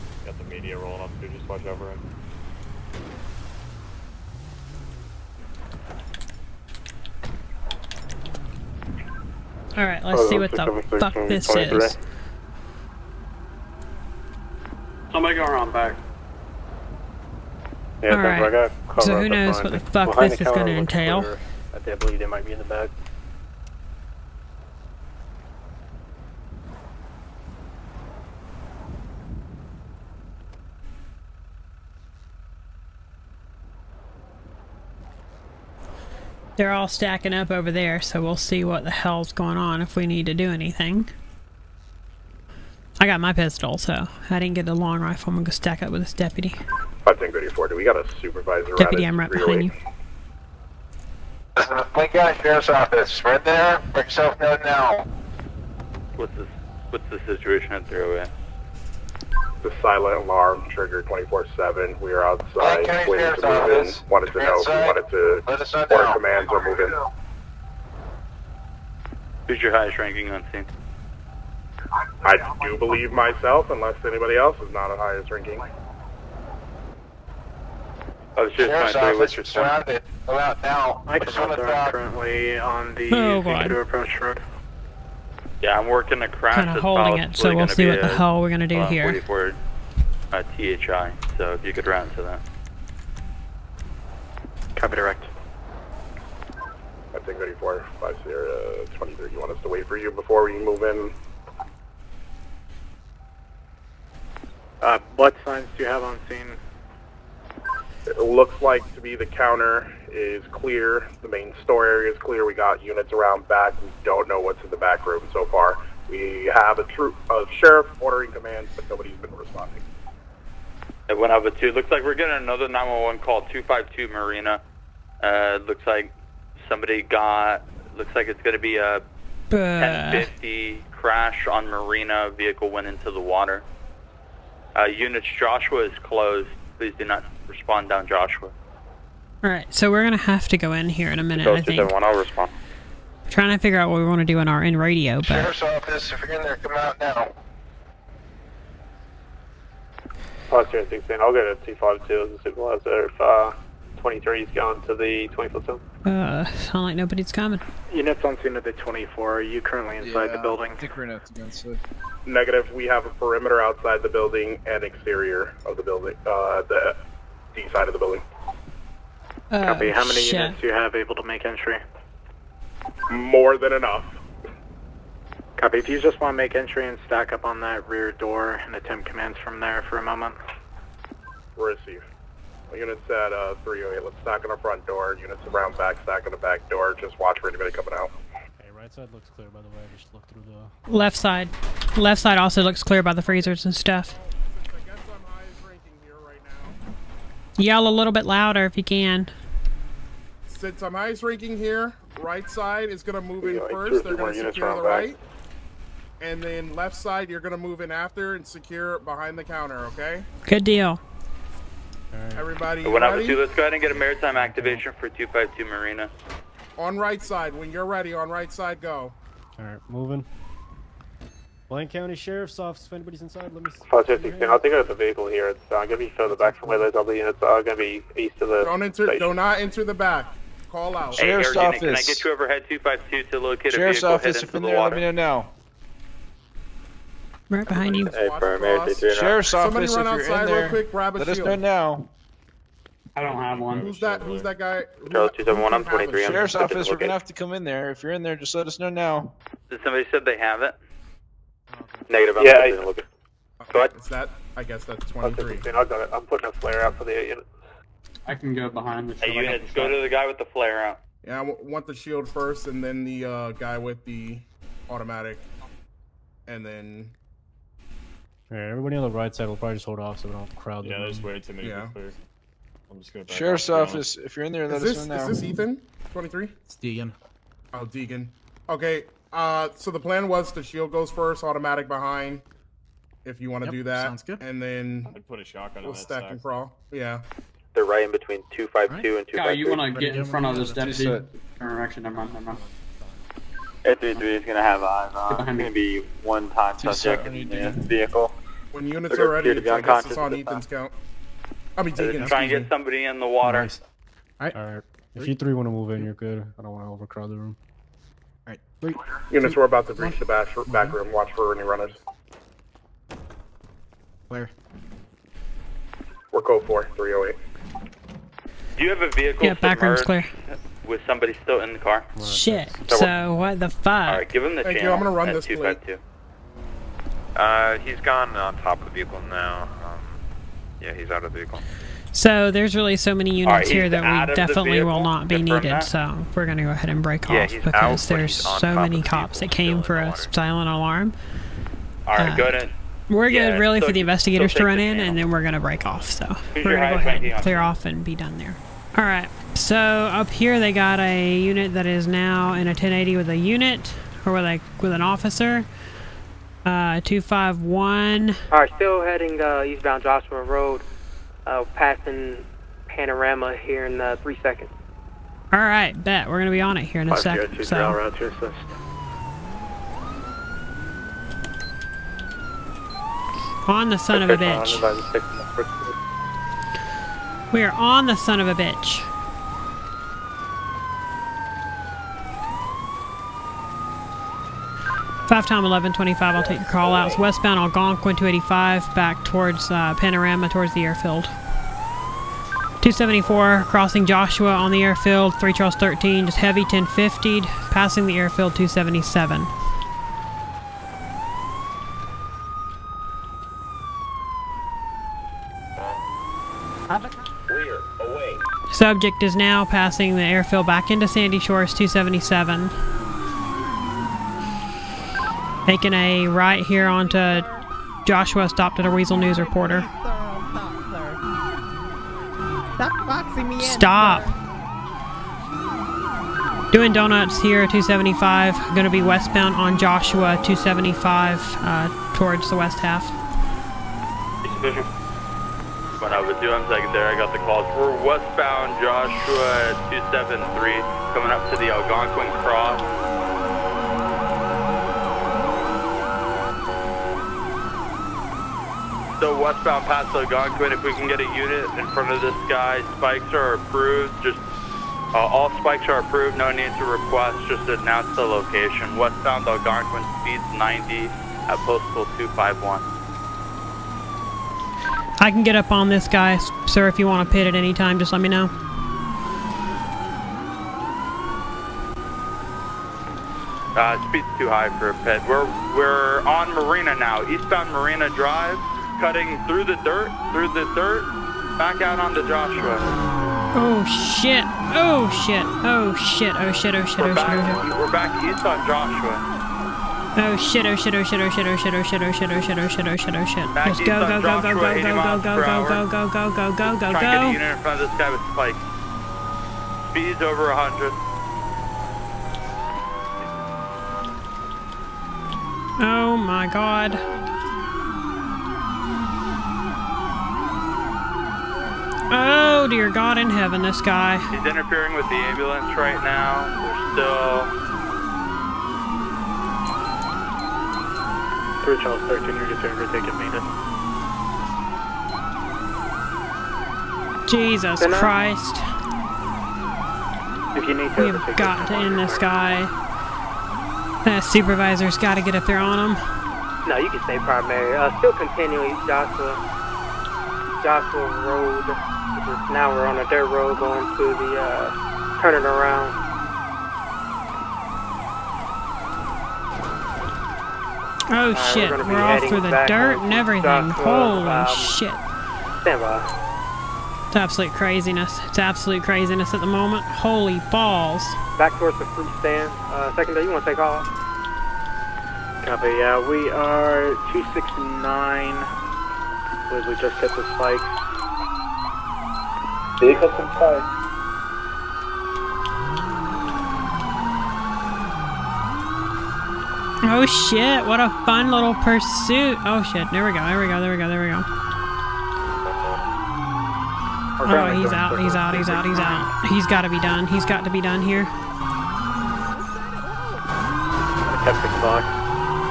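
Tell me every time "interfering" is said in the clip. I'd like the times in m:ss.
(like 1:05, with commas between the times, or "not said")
8:34.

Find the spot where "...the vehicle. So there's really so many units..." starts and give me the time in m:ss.
5:31.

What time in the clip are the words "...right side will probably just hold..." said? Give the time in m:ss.
4:29.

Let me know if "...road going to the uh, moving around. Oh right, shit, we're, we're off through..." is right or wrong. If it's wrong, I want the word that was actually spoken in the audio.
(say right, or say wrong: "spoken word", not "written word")
wrong: "turning", not "moving".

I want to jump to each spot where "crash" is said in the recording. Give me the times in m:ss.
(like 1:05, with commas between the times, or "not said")
1:26, 2:10.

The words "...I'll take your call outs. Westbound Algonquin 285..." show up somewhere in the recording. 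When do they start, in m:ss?
6:26.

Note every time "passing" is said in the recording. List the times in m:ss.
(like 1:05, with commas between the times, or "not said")
6:01, 6:37, 6:49.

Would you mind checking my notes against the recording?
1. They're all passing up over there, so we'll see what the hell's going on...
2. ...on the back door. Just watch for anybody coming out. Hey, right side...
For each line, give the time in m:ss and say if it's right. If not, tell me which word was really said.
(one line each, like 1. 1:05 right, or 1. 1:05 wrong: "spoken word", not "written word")
1. 0:36 wrong: "stacking", not "passing"
2. 3:06 right.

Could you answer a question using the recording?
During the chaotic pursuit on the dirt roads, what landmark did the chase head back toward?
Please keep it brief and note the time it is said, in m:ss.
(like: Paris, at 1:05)
The fruit stand, at 9:21.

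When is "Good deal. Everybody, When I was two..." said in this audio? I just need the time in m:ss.
3:30.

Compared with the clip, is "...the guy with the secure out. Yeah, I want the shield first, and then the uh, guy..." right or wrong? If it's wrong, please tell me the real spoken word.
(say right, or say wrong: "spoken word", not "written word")
wrong: "flare", not "secure".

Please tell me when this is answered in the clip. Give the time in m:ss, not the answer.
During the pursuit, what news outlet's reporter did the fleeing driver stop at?
6:58.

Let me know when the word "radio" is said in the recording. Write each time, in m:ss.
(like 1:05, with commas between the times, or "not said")
2:24.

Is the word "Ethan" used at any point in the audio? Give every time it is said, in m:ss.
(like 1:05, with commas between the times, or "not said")
4:35, 5:00.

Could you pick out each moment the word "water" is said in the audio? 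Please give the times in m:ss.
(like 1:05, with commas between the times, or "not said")
2:13, 3:54, 5:03.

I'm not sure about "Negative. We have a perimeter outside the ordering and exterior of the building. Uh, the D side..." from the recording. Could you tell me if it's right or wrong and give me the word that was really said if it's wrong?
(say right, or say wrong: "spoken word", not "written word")
wrong: "building", not "ordering".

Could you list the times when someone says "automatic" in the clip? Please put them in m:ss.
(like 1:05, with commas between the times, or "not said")
4:24, 4:41.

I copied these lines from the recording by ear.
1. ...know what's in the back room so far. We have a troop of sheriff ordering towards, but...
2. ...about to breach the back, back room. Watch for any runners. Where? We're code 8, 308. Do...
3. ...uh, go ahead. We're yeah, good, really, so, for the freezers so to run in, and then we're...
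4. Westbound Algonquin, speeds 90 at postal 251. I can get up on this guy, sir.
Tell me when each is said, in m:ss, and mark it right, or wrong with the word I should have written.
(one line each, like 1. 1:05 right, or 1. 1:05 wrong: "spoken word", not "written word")
1. 1:54 wrong: "commands", not "towards"
2. 5:09 wrong: "4", not "8"
3. 5:42 wrong: "investigators", not "freezers"
4. 7:38 right.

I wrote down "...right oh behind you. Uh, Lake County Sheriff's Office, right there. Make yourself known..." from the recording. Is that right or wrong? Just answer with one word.
right.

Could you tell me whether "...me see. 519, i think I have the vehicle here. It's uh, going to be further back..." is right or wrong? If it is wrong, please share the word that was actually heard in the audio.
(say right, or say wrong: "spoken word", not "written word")
wrong: "516", not "519".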